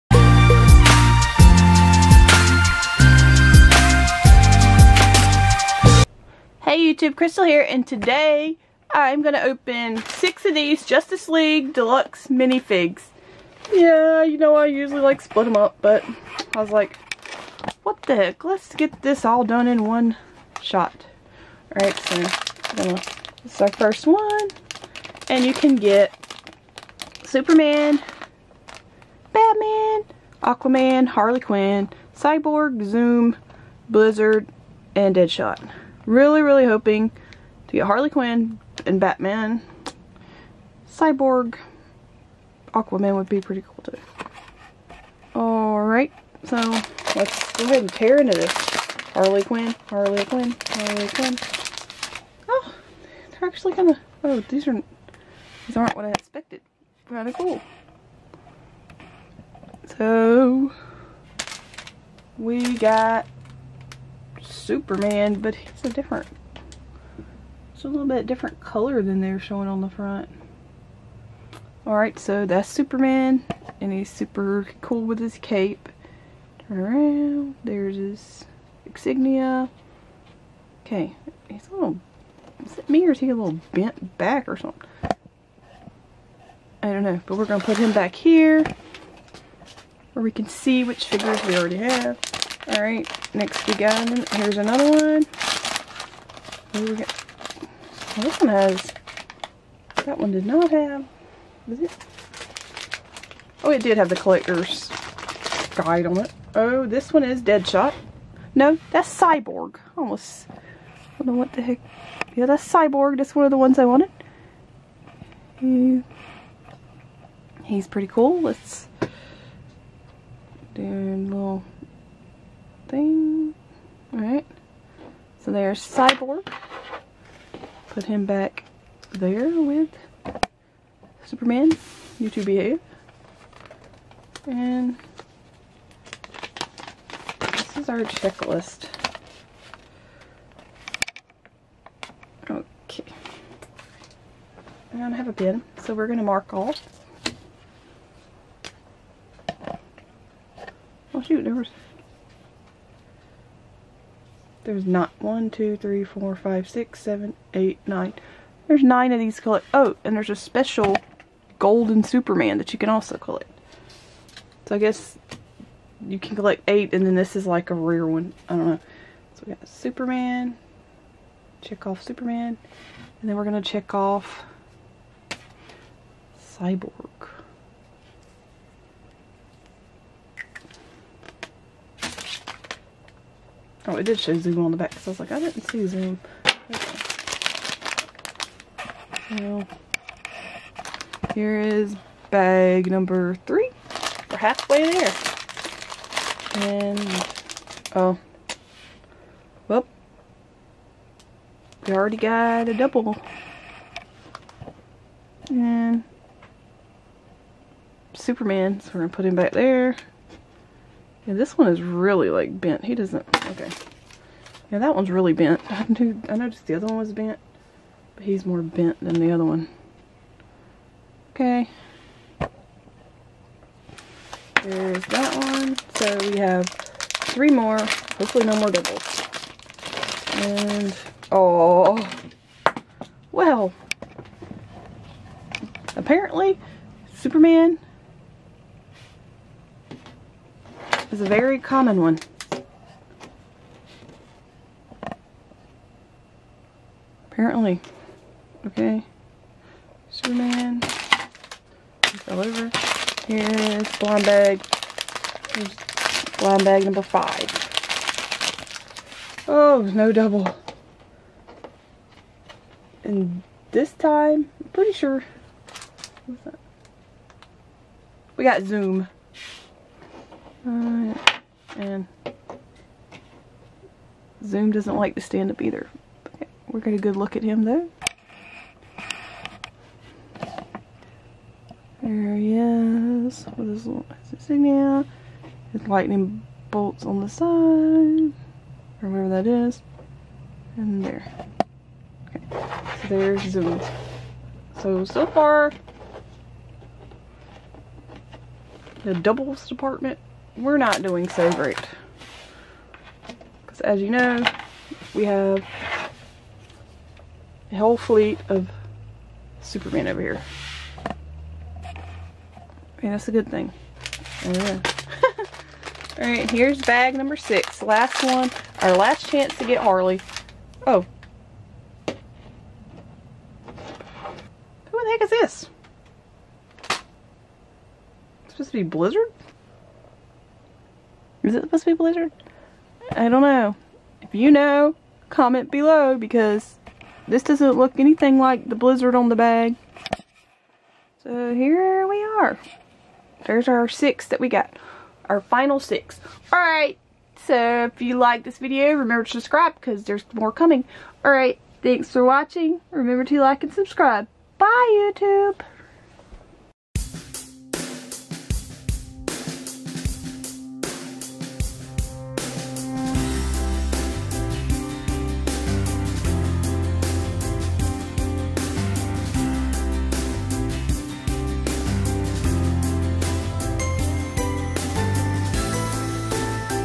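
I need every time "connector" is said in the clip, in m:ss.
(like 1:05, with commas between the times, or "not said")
not said.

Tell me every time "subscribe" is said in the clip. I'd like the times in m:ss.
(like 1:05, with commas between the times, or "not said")
5:49, 5:53.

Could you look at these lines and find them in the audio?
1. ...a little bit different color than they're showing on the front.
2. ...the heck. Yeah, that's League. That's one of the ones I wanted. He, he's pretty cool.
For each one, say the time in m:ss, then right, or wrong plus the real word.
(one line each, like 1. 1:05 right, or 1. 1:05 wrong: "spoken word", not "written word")
1. 1:07 right
2. 1:51 wrong: "Cyborg", not "League".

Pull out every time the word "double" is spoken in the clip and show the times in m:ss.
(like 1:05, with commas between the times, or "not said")
3:22, 3:48, 4:20, 4:59.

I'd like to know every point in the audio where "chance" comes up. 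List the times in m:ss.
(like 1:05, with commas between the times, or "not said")
5:19.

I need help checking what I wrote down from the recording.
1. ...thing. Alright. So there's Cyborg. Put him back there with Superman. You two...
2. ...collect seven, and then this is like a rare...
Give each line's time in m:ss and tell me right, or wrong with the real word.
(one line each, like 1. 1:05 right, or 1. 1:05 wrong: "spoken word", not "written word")
1. 2:02 right
2. 2:46 wrong: "eight", not "seven".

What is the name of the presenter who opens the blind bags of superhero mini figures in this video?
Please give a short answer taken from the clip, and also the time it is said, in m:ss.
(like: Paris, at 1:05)
Crystal, at 0:07.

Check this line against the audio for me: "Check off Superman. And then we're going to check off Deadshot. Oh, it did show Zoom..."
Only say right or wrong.
wrong.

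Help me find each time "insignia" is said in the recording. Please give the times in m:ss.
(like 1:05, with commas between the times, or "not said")
1:18, 4:44.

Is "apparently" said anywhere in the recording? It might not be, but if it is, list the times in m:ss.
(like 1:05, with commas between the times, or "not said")
3:55, 4:07.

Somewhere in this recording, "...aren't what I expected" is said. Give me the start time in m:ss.
0:55.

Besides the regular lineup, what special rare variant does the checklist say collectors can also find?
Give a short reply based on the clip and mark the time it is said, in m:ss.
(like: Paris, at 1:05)
golden Superman, at 2:41.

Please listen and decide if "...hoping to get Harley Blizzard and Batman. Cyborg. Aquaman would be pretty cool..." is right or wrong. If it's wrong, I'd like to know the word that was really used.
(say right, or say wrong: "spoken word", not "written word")
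wrong: "Quinn", not "Blizzard".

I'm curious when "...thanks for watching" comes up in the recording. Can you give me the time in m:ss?
5:51.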